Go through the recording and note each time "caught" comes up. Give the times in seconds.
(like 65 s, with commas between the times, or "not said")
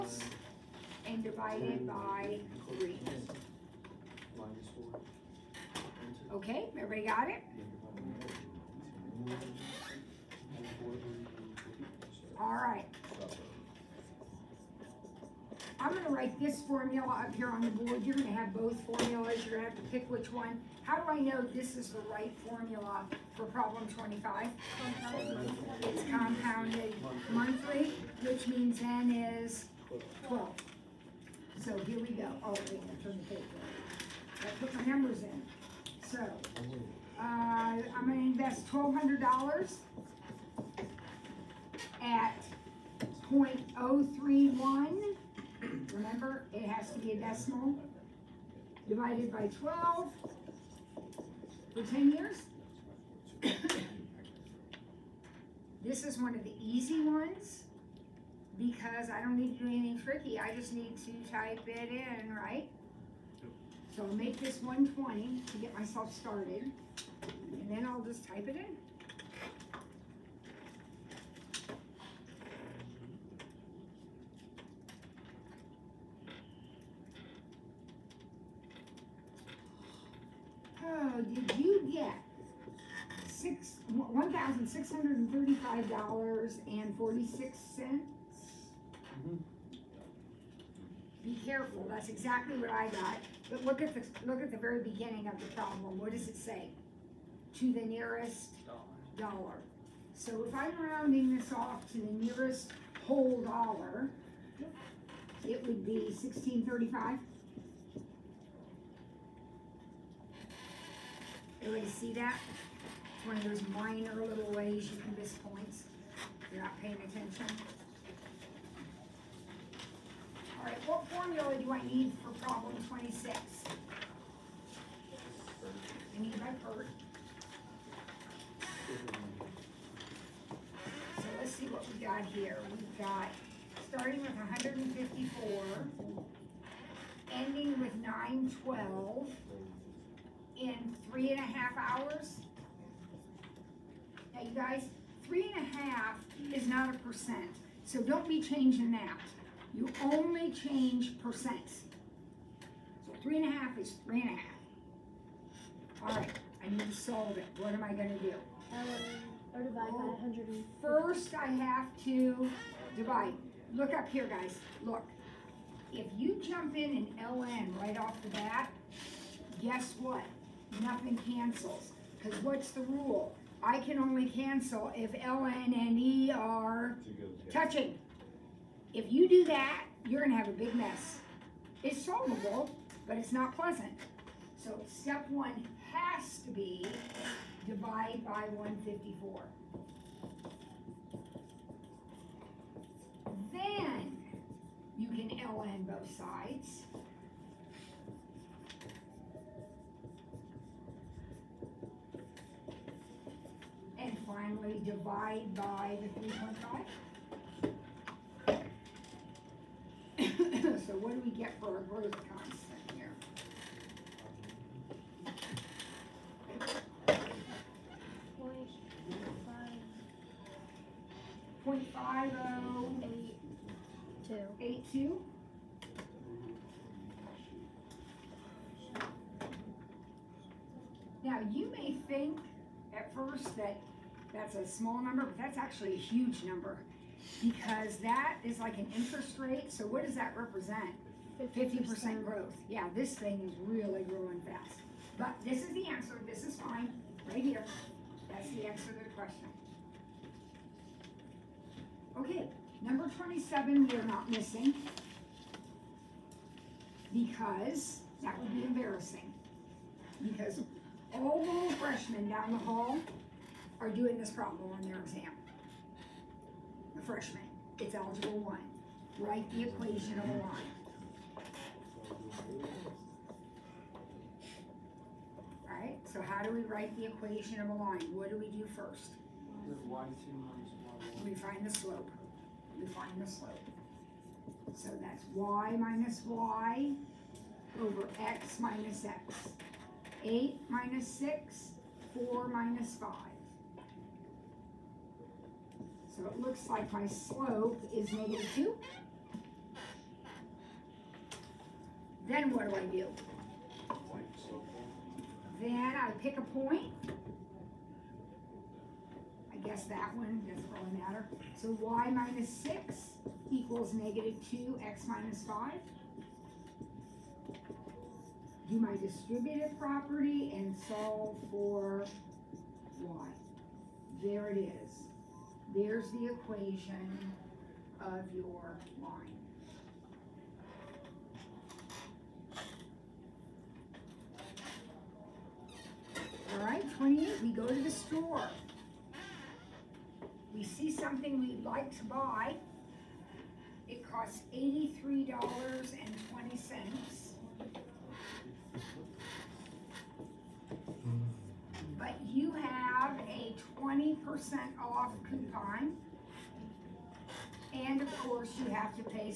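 not said.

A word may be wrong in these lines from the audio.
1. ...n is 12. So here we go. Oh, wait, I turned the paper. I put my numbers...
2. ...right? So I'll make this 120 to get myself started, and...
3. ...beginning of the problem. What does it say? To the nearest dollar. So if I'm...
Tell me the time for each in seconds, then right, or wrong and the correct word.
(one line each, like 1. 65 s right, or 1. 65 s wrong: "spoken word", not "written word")
1. 28 s right
2. 62 s right
3. 94 s right.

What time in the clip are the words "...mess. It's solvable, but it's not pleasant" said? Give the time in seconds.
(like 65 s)
180 s.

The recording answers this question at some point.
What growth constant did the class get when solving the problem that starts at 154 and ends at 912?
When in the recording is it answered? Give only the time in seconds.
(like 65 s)
221 s.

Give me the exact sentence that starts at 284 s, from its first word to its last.
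So that's y minus y over x minus x.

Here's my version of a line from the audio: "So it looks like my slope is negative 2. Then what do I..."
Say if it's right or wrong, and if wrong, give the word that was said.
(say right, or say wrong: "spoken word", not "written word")
right.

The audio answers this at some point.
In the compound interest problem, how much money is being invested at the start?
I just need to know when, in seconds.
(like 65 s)
38 s.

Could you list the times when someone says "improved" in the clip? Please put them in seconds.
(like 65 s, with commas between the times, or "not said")
not said.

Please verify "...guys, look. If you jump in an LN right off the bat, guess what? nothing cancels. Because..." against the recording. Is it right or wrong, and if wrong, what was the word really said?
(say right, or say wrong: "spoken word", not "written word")
right.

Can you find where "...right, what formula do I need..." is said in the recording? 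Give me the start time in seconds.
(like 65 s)
120 s.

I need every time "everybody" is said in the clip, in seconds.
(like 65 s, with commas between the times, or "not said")
6 s, 111 s.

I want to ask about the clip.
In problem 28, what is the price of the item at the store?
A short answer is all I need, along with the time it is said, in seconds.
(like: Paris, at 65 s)
$83.20, at 344 s.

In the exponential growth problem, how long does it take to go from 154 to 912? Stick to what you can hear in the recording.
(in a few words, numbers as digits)
3.5 hours.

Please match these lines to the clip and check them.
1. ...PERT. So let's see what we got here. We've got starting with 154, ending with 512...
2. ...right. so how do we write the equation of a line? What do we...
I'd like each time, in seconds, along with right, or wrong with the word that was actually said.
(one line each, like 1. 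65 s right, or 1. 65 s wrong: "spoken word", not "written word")
1. 126 s wrong: "912", not "512"
2. 275 s right.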